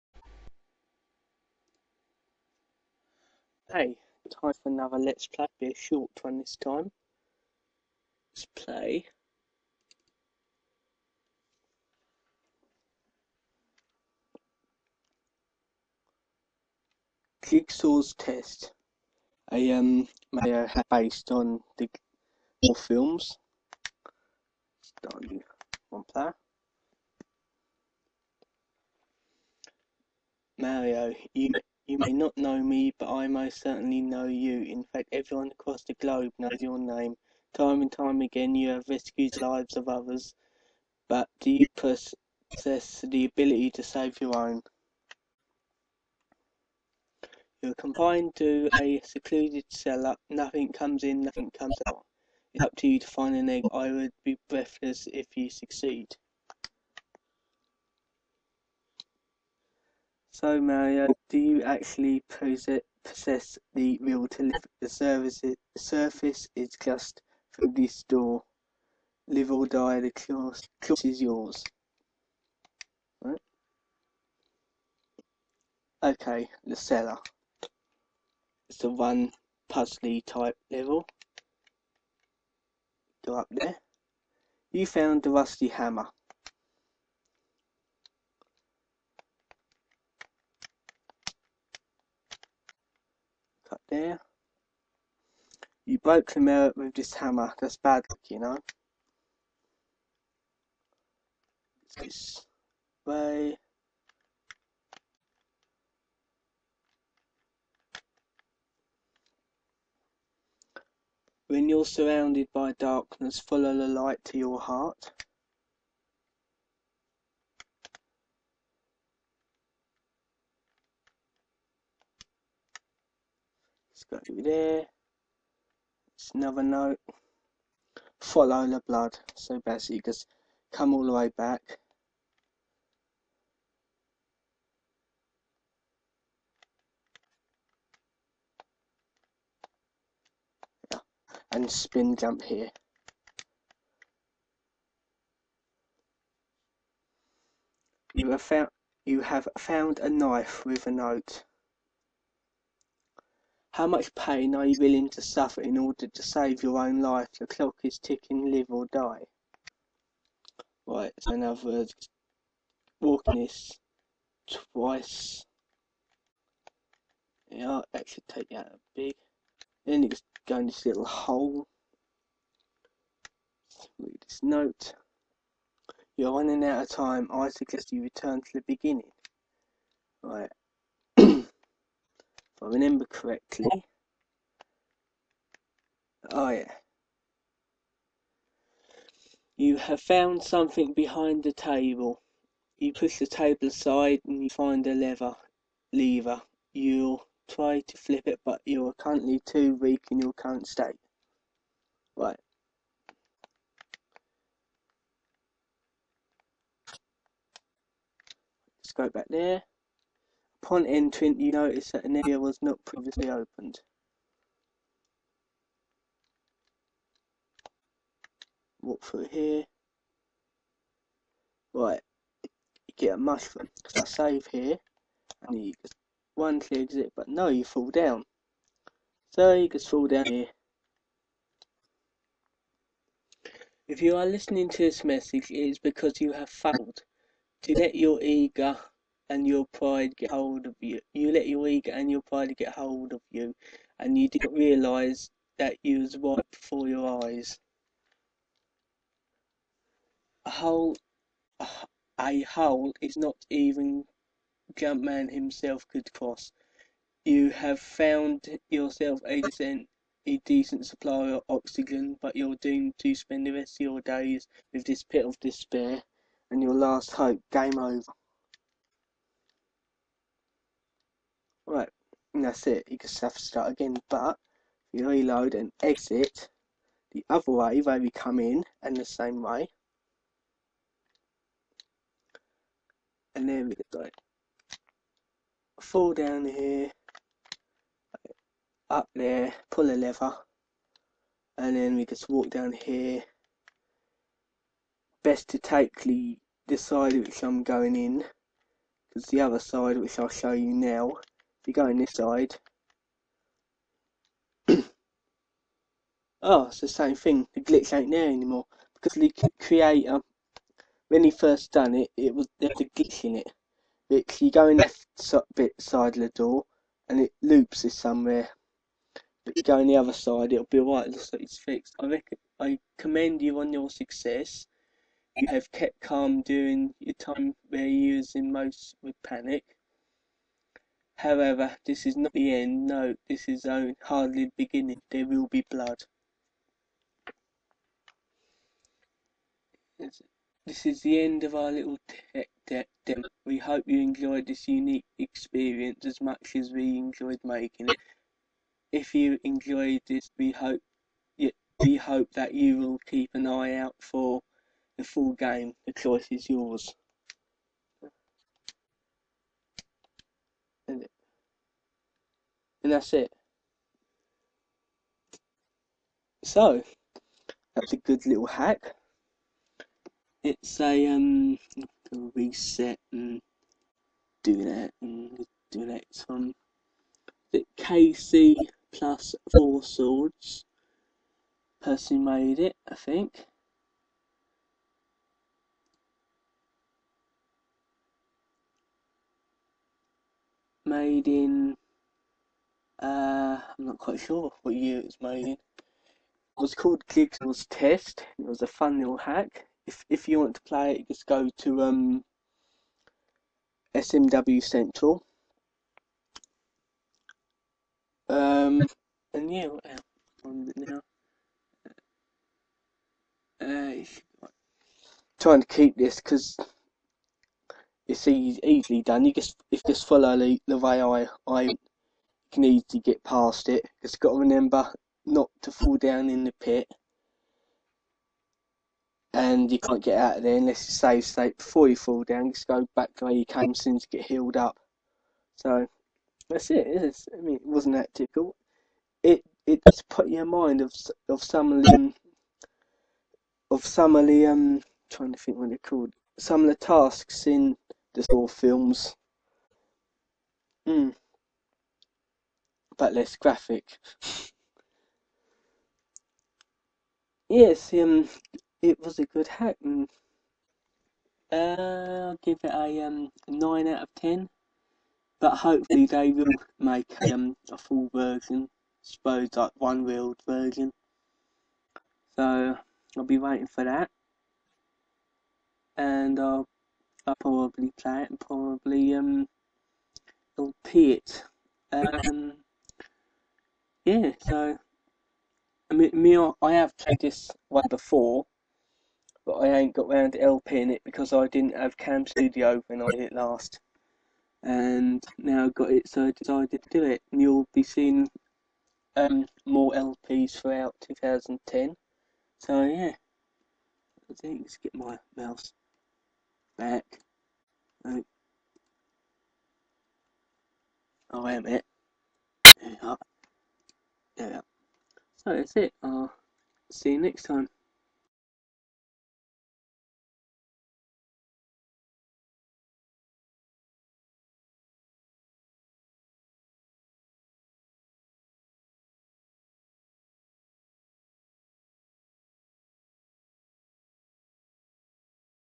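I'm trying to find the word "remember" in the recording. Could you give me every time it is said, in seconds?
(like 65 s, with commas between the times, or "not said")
182 s, 424 s.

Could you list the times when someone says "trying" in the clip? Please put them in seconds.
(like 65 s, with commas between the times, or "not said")
415 s, 445 s.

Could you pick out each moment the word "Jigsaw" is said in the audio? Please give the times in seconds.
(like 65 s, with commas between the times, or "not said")
17 s, 397 s.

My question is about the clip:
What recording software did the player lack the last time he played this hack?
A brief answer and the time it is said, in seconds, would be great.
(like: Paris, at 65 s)
Cam Studio, at 491 s.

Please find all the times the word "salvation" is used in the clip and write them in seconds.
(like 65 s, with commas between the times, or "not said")
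not said.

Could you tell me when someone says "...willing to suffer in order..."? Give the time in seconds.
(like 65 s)
154 s.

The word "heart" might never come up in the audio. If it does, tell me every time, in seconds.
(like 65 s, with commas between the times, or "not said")
114 s.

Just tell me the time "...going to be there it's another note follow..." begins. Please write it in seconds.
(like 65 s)
124 s.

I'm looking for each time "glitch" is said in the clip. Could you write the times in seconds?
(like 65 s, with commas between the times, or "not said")
307 s, 312 s.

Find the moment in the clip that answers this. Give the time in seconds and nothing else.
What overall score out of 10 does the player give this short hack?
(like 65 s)
463 s.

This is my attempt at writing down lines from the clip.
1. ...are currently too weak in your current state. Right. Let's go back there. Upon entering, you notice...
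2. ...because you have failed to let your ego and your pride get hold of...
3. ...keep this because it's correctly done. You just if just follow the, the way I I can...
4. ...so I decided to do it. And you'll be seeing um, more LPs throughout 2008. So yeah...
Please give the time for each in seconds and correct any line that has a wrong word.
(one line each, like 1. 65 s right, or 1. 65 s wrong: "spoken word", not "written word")
1. 198 s right
2. 235 s right
3. 415 s wrong: "easily", not "correctly"
4. 496 s wrong: "2010", not "2008".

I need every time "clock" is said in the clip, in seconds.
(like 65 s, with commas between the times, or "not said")
157 s.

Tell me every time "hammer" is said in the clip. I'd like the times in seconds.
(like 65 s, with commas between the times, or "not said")
85 s, 97 s.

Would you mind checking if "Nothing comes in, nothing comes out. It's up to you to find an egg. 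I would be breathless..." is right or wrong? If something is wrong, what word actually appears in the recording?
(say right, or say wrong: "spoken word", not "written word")
right.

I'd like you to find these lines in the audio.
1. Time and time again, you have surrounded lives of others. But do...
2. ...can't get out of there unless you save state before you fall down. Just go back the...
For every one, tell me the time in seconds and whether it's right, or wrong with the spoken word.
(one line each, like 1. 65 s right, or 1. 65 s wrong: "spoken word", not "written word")
1. 37 s wrong: "rescued", not "surrounded"
2. 429 s right.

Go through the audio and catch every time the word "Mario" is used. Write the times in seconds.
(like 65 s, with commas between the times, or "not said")
20 s, 30 s, 60 s.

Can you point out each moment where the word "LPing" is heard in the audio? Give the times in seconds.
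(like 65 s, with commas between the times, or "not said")
490 s.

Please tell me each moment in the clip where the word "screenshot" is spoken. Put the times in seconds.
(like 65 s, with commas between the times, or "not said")
not said.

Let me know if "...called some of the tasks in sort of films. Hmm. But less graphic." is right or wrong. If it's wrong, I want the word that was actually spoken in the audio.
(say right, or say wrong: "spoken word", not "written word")
right.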